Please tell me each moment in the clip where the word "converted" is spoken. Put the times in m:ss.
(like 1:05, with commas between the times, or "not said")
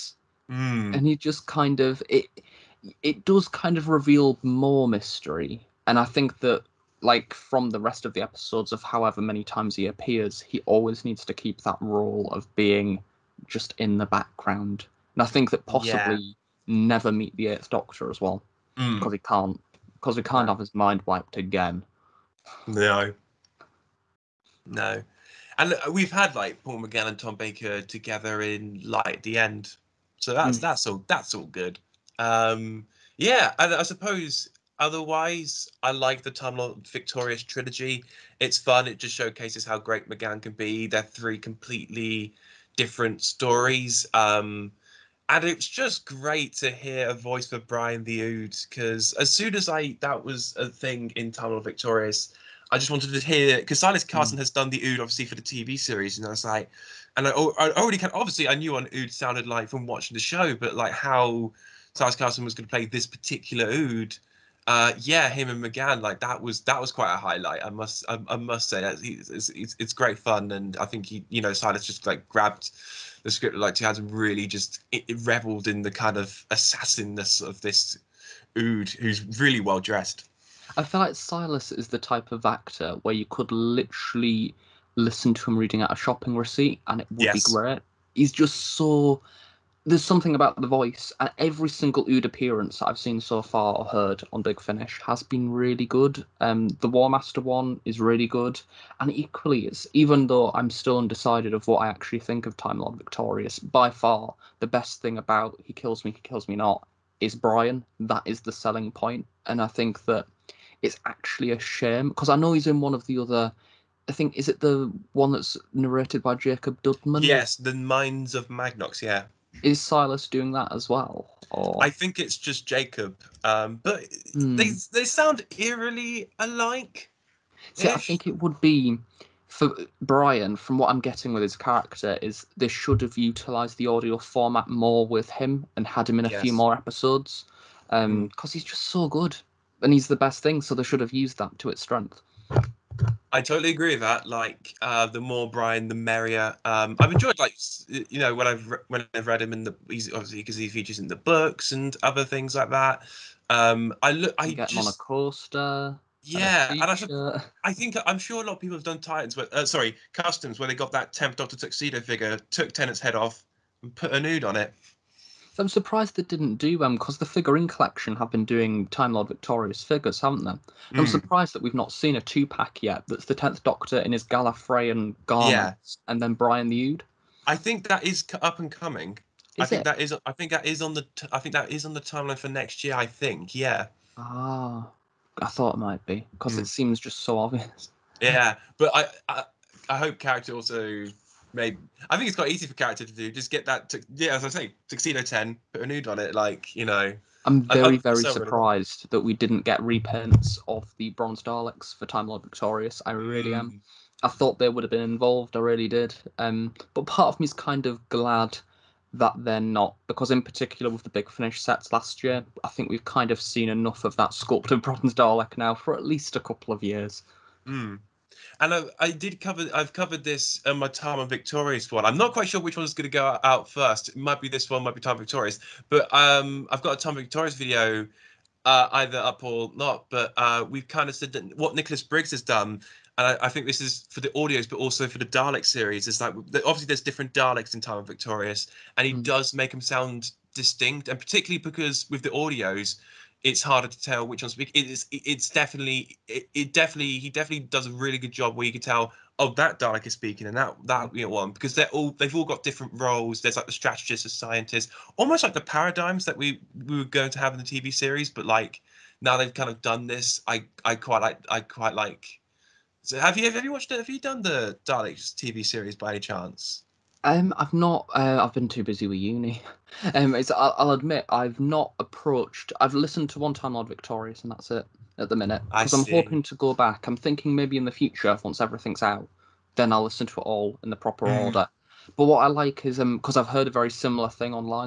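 not said.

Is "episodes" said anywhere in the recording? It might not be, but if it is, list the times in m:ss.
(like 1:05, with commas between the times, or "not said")
0:08, 2:16.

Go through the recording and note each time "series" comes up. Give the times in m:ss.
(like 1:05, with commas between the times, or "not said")
0:55, 3:55, 4:17, 4:25.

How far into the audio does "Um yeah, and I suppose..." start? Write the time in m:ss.
0:32.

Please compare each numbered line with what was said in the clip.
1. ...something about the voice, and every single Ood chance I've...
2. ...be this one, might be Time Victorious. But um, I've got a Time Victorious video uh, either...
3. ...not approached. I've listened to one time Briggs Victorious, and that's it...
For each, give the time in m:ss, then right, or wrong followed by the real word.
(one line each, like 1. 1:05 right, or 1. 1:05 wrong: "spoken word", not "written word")
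1. 1:30 wrong: "appearance", not "chance"
2. 3:44 right
3. 4:31 wrong: "Lord", not "Briggs".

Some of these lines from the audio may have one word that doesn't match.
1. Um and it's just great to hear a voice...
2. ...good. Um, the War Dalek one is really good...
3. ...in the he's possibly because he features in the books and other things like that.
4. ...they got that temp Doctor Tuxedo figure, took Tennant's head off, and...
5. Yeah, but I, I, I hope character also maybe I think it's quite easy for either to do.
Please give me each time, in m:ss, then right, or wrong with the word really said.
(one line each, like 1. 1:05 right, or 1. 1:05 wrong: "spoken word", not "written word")
1. 0:44 right
2. 1:35 wrong: "Master", not "Dalek"
3. 2:29 wrong: "obviously", not "possibly"
4. 2:40 right
5. 3:08 wrong: "character", not "either".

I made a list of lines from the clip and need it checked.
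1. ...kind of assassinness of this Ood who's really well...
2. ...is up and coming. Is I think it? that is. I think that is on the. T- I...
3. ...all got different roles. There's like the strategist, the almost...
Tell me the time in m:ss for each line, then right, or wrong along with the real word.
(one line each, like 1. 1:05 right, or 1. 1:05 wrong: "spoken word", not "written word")
1. 1:15 right
2. 2:58 right
3. 4:12 wrong: "scientist", not "almost".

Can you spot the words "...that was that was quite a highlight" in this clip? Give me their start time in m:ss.
1:06.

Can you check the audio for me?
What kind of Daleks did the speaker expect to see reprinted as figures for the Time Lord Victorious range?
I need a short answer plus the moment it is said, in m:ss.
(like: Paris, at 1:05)
Bronze Daleks, at 3:21.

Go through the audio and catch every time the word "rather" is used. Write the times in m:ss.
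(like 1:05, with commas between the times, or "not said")
not said.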